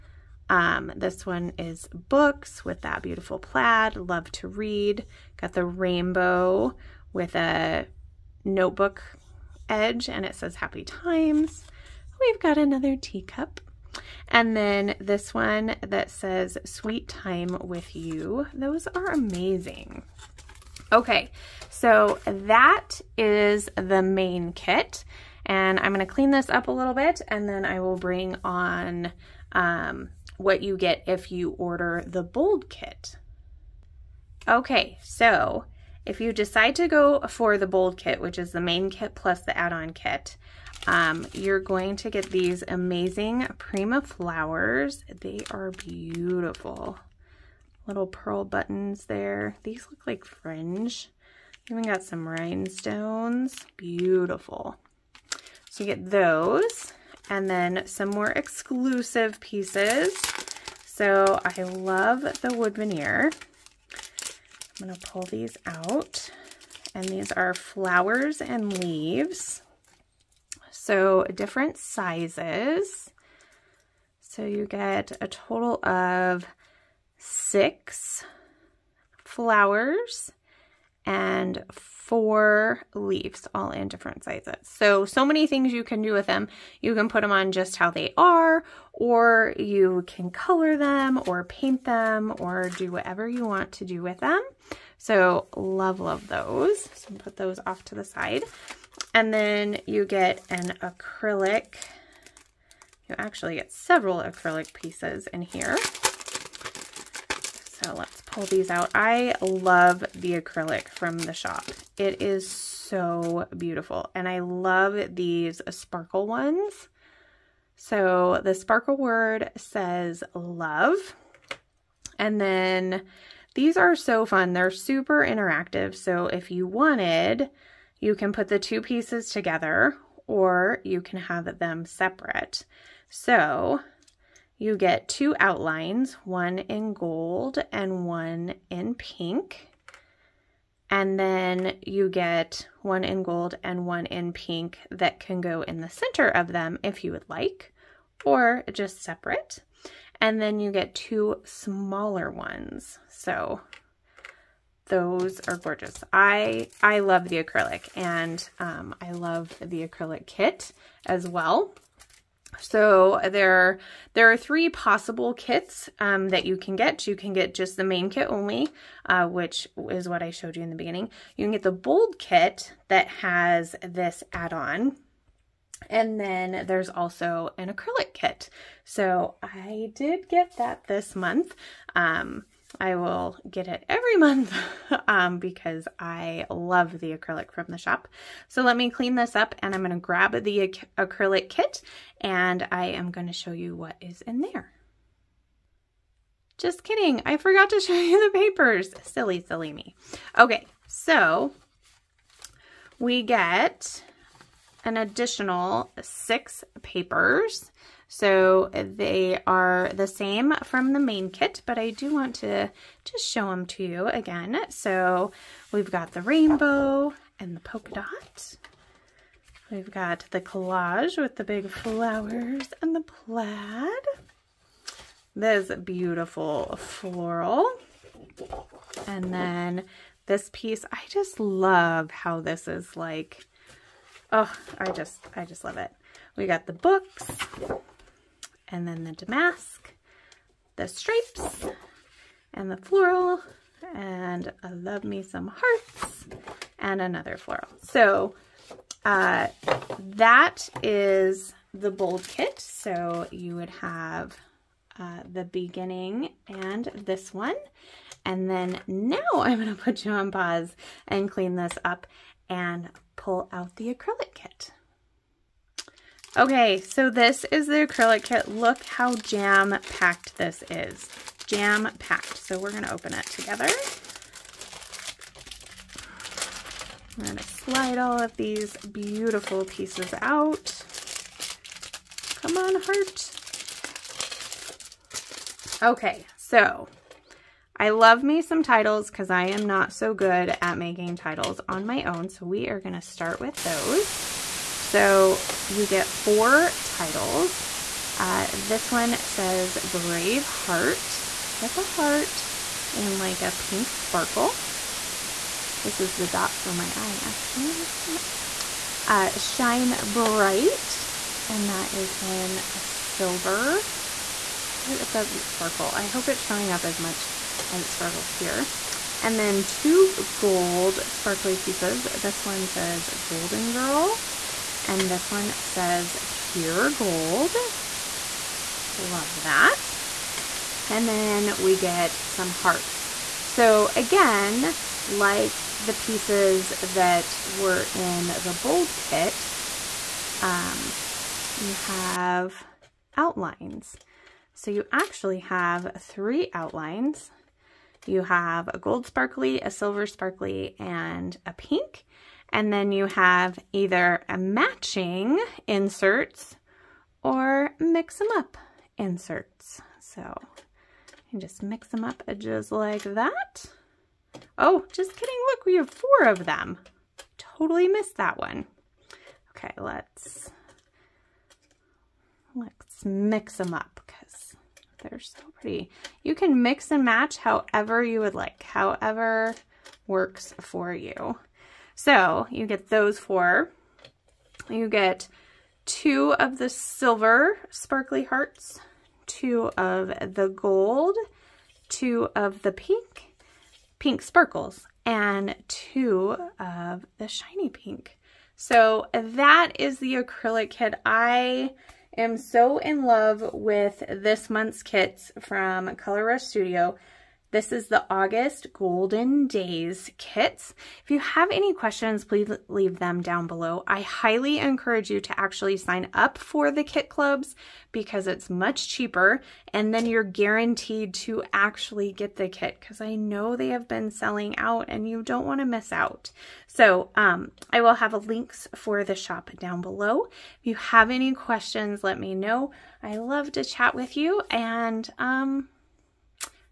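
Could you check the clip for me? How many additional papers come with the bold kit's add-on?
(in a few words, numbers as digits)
6.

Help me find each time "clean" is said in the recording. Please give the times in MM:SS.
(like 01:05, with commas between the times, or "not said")
00:26, 03:08, 04:21.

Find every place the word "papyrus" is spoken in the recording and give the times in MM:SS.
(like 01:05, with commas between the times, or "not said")
not said.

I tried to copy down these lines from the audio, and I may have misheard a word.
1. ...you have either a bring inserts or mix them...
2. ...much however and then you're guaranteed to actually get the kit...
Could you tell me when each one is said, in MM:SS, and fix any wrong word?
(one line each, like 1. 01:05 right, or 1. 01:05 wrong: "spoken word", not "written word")
1. 05:52 wrong: "matching", not "bring"
2. 06:58 wrong: "cheaper", not "however".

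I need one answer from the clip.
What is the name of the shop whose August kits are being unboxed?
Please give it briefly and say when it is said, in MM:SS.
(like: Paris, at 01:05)
Color Rush Studio, at 06:45.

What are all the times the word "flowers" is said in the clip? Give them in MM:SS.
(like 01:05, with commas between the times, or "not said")
00:44, 01:07, 01:19, 03:41.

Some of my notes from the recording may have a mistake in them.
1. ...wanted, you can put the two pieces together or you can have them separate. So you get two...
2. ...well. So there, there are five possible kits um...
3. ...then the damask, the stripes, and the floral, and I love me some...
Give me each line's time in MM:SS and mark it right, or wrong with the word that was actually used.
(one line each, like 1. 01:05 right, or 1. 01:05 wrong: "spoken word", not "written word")
1. 02:06 right
2. 02:41 wrong: "three", not "five"
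3. 03:58 right.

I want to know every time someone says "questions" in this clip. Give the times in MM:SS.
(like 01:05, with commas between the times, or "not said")
06:51, 07:11.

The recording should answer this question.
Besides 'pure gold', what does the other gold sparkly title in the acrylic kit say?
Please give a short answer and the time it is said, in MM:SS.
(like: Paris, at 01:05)
Golden Girl, at 05:23.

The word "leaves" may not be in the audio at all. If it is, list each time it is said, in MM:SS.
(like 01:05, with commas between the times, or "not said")
01:08, 01:22, 06:52.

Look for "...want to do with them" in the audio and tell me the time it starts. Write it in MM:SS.
01:33.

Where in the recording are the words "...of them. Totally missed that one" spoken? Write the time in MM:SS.
06:06.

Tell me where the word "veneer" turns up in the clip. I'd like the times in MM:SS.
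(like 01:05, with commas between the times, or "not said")
01:02.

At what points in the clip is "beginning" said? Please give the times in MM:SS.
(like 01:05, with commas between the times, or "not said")
02:50, 04:15.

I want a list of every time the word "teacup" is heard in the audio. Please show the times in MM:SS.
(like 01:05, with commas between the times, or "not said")
00:12.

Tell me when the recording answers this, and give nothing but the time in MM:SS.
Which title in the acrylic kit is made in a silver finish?
05:09.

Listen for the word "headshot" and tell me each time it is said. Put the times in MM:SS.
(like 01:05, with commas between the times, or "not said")
not said.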